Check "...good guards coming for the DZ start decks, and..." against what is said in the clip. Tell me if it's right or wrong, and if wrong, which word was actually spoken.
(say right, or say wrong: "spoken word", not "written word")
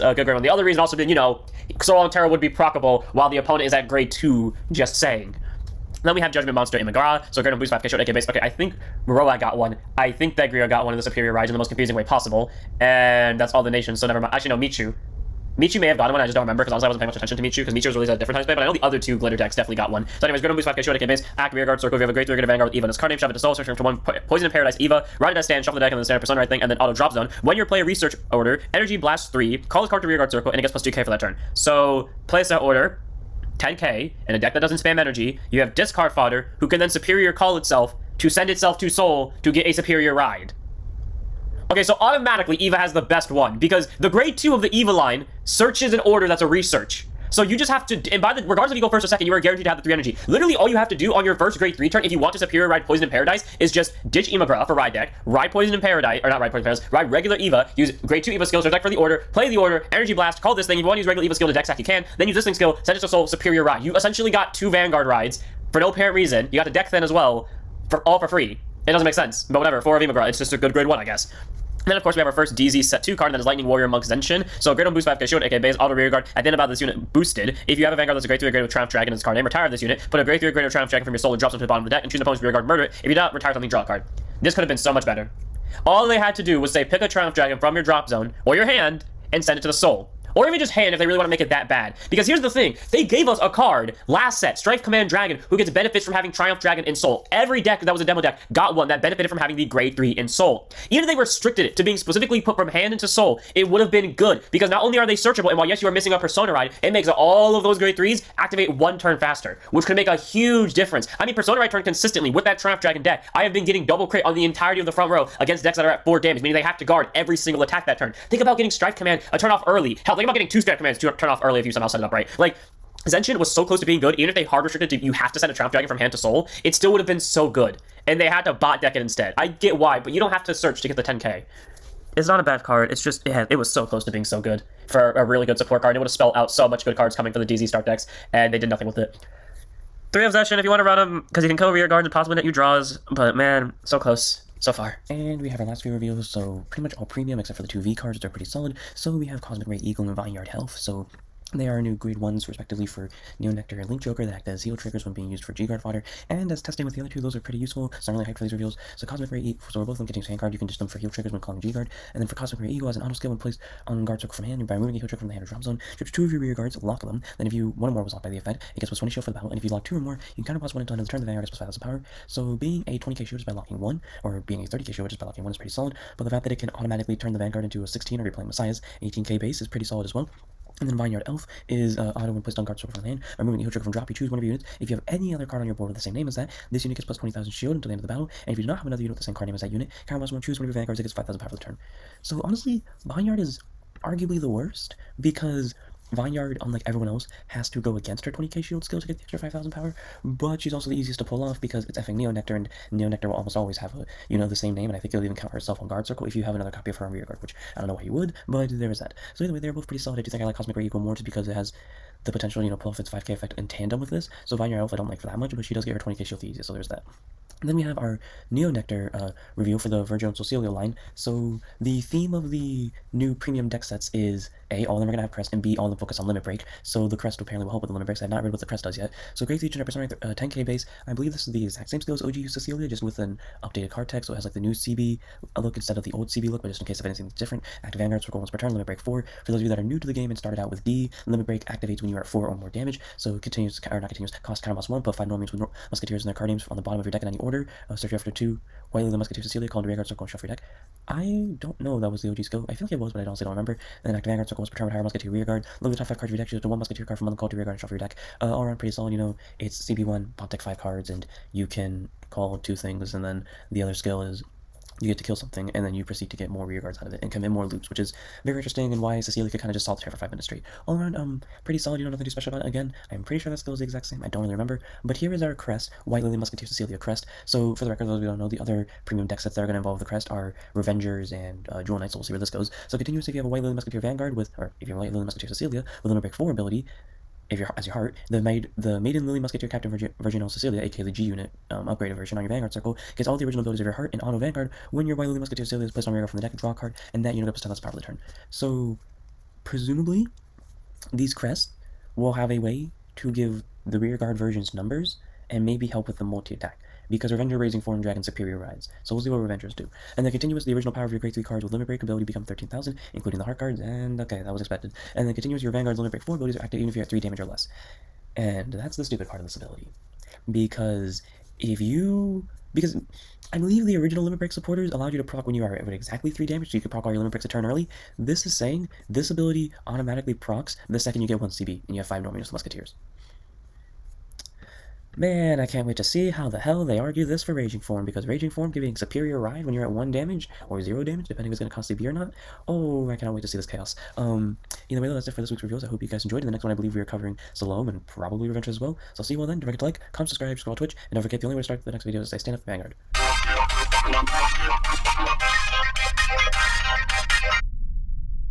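wrong: "cards", not "guards".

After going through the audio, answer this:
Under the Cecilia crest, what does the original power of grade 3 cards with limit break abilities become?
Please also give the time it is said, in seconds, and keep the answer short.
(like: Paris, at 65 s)
13,000, at 312 s.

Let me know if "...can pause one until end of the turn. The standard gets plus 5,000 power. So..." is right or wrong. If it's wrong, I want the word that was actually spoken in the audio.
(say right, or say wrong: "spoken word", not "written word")
wrong: "vanguard", not "standard".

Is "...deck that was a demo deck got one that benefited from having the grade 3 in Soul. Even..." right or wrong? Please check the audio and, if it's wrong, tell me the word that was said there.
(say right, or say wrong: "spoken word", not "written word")
right.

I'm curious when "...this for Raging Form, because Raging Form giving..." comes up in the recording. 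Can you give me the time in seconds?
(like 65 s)
337 s.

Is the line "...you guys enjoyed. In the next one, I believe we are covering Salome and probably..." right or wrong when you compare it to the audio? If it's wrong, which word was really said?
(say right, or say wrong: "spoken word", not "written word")
right.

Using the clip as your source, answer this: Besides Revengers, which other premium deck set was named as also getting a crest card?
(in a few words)
Jewel Knight.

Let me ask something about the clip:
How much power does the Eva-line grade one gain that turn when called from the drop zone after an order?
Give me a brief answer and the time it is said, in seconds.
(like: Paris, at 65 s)
2k, at 30 s.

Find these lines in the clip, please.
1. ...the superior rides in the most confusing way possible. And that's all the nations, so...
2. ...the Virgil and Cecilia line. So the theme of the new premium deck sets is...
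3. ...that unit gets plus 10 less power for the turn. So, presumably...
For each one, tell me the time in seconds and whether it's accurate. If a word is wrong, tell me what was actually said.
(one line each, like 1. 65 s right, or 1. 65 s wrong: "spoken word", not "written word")
1. 10 s right
2. 219 s right
3. 297 s right.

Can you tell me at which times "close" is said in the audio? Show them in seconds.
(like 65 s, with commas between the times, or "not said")
123 s, 133 s, 143 s.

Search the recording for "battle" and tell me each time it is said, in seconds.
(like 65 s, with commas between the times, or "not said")
169 s, 188 s.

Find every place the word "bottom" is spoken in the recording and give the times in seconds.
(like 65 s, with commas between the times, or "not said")
81 s, 246 s.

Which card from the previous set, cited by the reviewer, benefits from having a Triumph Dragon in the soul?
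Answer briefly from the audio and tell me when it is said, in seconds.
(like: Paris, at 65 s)
Strife Command Dragon, at 94 s.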